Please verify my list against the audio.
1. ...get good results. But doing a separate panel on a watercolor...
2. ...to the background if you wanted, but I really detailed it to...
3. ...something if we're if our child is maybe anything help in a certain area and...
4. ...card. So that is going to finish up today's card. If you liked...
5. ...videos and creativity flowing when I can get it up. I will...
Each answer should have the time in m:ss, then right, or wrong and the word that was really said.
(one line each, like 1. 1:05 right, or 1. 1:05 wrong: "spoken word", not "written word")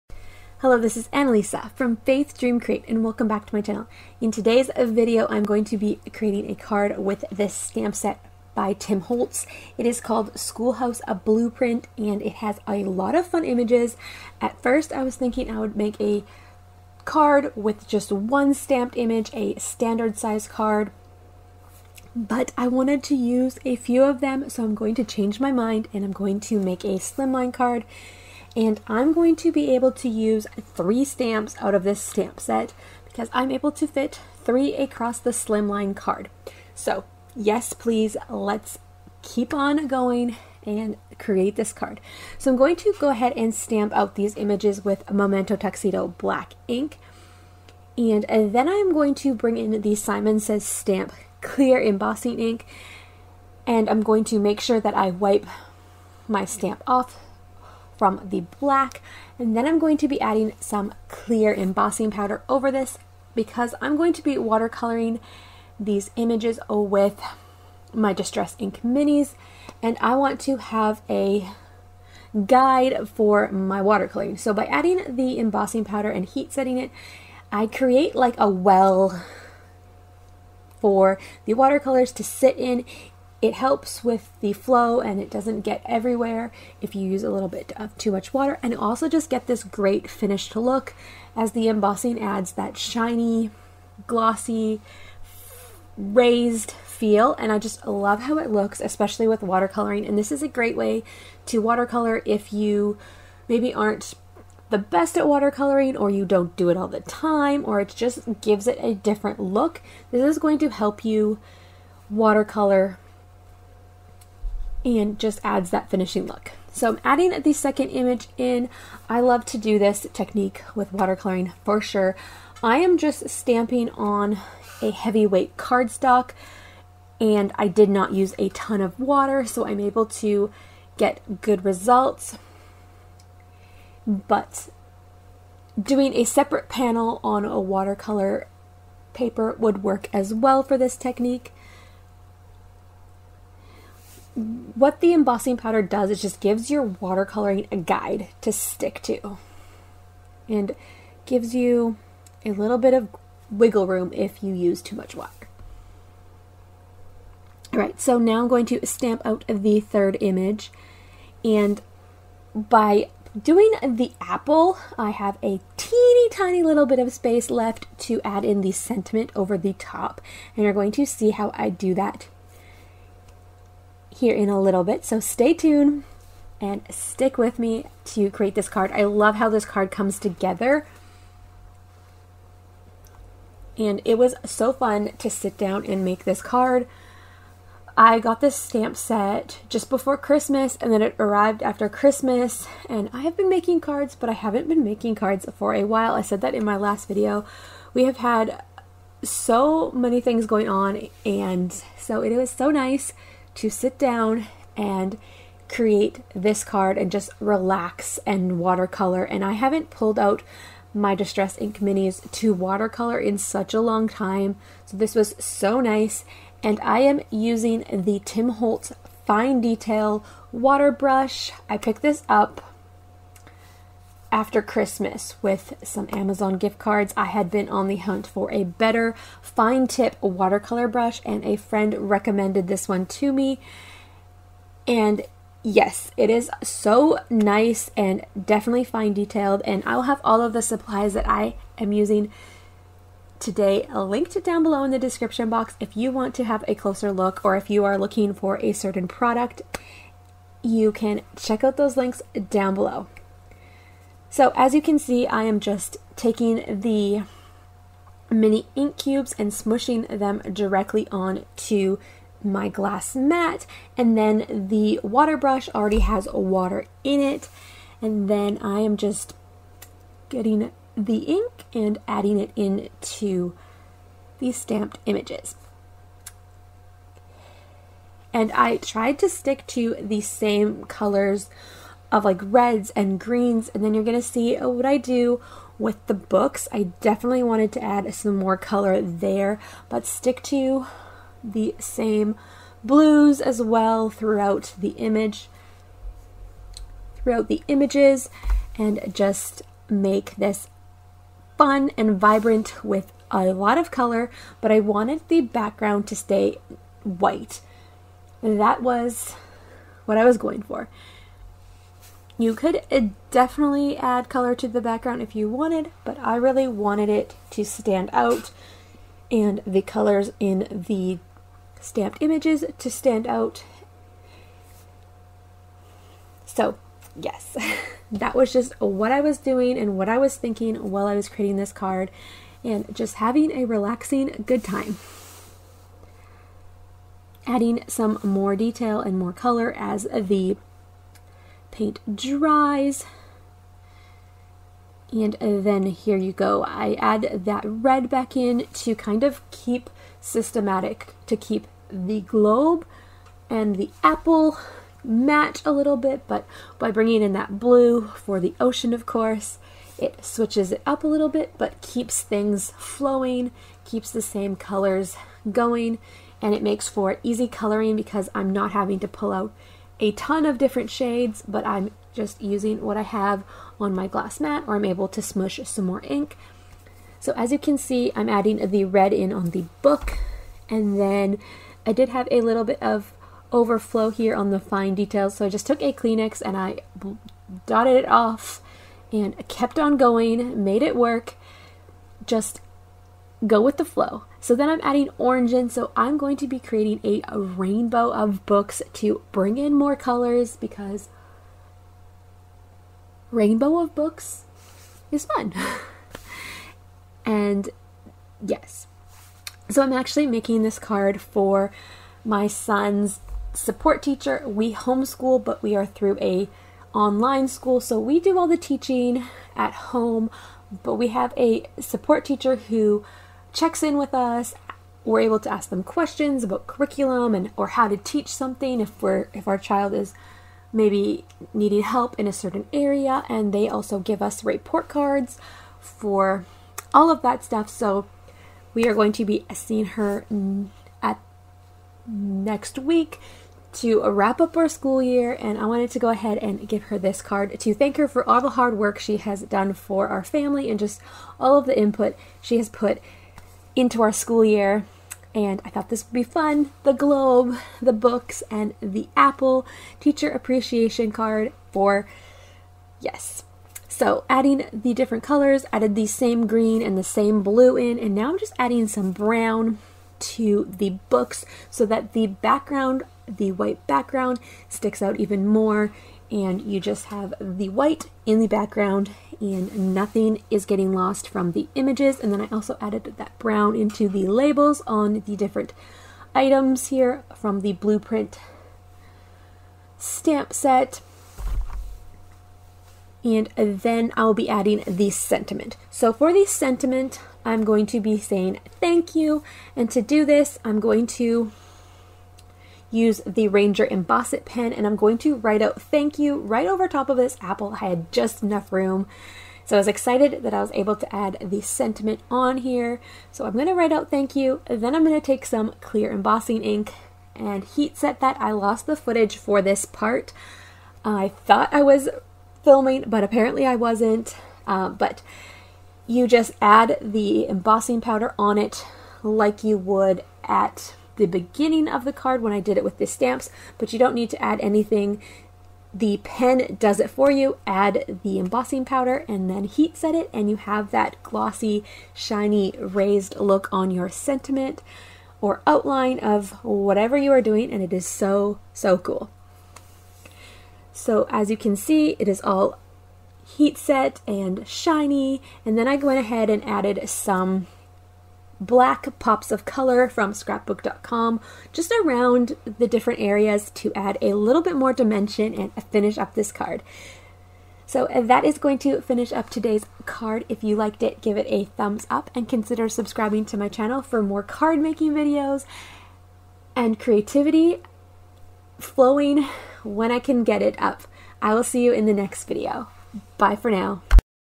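1. 2:10 right
2. 5:14 wrong: "wanted", not "detailed"
3. 7:08 wrong: "needing", not "anything"
4. 9:26 right
5. 9:35 right.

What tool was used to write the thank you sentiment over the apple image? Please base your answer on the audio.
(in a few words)
Ranger Embossed pen.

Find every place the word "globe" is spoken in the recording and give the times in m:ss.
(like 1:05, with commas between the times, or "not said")
5:52, 7:36.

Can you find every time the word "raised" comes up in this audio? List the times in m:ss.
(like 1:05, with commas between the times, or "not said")
1:35, 9:02.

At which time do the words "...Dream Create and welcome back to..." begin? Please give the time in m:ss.
0:02.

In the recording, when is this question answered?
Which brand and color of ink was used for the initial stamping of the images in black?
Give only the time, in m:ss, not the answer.
0:45.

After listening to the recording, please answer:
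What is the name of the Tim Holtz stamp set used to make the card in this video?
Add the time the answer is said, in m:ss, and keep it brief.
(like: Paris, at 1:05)
Schoolhouse A Blueprint, at 0:10.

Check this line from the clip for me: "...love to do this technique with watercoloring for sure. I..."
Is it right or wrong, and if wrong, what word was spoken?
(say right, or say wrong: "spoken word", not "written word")
right.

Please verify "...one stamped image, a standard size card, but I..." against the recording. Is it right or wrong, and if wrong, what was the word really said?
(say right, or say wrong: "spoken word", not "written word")
right.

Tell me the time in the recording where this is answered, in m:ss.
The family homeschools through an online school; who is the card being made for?
6:52.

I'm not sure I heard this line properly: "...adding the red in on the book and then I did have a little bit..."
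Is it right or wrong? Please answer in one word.
right.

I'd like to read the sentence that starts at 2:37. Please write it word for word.
All right, so now I'm going to stamp out the third image.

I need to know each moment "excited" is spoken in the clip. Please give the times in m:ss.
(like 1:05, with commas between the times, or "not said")
8:29.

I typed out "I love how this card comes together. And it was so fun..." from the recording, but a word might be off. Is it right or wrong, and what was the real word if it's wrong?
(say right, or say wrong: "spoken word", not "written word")
right.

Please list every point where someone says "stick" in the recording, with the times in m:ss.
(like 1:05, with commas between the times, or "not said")
2:28, 2:56, 4:39, 4:50, 7:54.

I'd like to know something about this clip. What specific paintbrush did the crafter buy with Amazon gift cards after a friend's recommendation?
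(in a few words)
Tim Holtz Fine Detail Water Brush.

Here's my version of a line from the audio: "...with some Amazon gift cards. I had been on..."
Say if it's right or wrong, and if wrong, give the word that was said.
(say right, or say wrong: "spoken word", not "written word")
right.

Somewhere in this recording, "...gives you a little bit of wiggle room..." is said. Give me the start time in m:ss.
2:31.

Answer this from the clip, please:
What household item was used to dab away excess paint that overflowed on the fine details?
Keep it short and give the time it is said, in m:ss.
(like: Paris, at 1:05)
Kleenex, at 6:25.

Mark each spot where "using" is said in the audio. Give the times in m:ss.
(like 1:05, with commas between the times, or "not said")
3:37, 4:01, 6:12.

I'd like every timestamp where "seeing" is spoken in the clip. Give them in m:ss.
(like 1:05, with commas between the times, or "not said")
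7:19.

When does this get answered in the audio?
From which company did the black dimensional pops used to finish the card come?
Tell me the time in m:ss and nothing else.
9:20.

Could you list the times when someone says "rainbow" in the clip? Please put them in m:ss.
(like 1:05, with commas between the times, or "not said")
6:37, 6:43.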